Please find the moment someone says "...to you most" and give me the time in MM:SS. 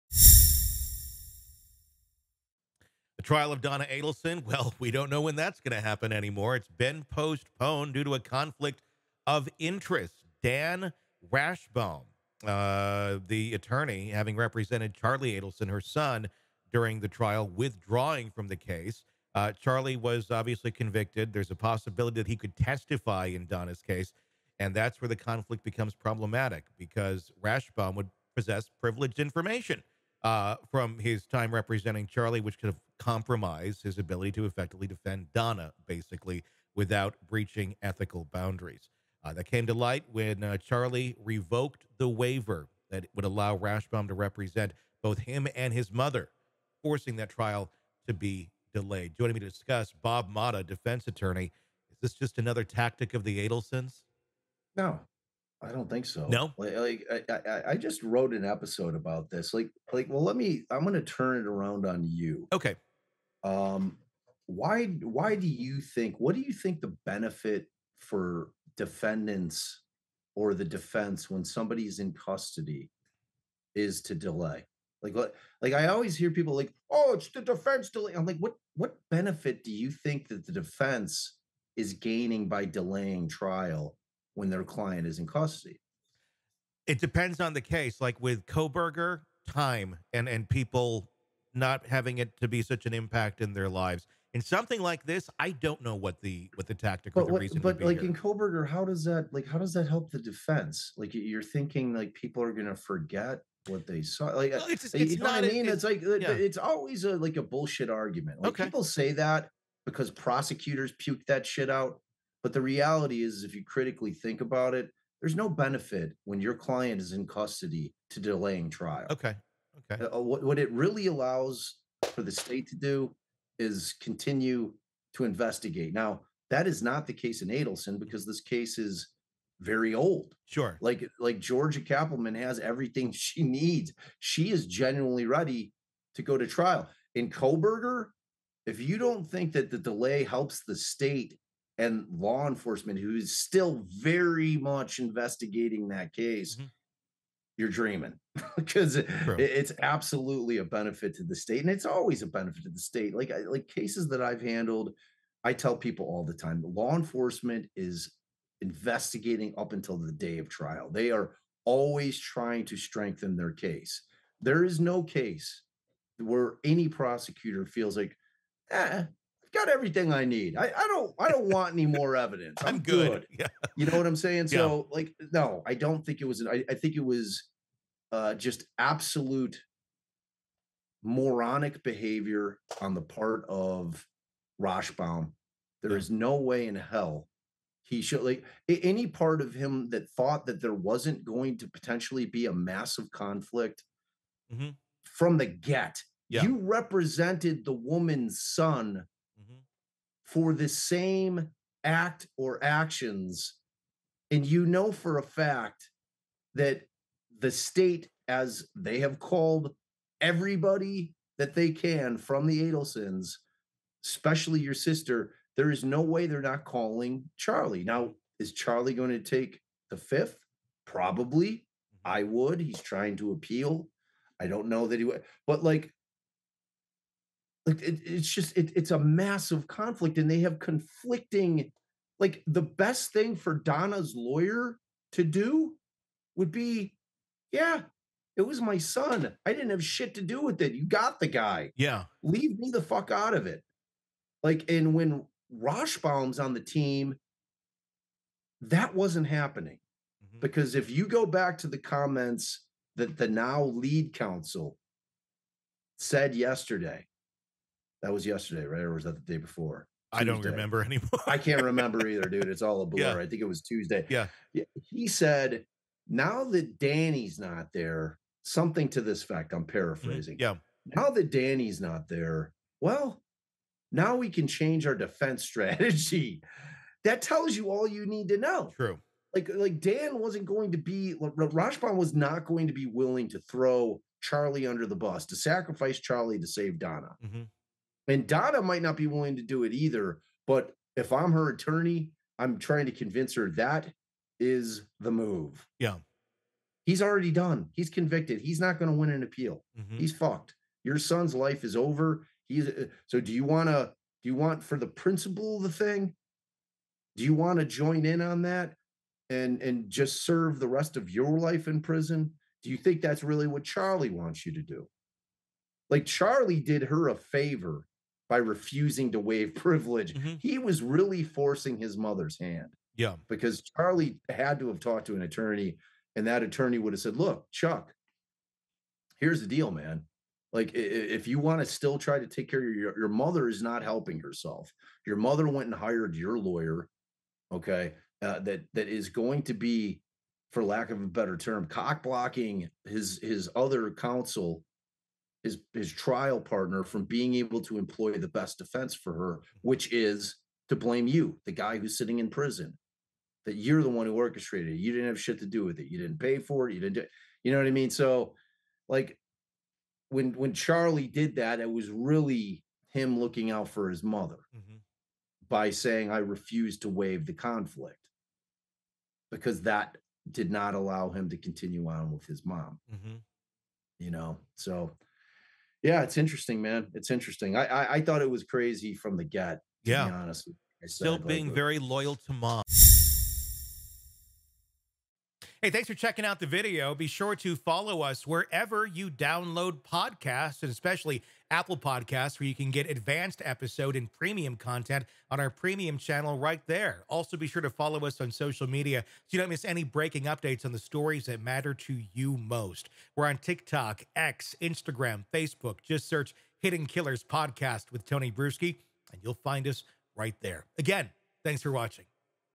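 06:41.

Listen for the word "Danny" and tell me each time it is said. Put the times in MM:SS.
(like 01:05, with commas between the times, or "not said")
04:26, 04:31.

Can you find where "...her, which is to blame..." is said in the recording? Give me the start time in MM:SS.
05:49.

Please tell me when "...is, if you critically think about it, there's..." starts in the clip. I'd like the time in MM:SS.
01:53.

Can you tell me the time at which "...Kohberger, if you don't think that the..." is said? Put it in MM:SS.
02:17.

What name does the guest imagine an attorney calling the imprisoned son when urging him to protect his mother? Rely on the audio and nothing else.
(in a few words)
Chuck.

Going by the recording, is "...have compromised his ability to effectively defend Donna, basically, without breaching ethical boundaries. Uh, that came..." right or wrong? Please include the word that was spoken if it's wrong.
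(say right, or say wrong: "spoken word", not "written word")
right.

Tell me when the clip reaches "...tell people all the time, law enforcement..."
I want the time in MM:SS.
02:35.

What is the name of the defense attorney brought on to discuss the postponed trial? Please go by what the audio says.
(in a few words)
Bob Motta.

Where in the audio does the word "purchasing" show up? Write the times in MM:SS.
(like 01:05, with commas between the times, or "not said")
not said.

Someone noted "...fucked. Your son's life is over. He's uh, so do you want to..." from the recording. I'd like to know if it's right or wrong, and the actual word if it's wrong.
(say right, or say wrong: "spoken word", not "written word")
right.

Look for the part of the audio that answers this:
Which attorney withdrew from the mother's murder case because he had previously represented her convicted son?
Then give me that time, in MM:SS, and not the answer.
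00:10.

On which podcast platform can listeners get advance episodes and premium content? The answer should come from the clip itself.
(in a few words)
Apple Podcasts.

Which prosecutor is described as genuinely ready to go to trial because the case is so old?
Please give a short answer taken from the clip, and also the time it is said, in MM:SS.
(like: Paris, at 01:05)
Georgia Cappleman, at 02:11.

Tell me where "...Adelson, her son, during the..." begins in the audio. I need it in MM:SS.
00:15.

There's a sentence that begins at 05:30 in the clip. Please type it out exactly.
Like, if you want to still try to take care of your, your mother, is not helping herself.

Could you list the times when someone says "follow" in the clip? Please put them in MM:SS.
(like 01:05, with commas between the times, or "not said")
06:27, 06:37.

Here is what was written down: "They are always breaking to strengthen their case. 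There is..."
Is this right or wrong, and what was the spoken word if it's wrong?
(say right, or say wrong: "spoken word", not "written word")
wrong: "trying", not "breaking".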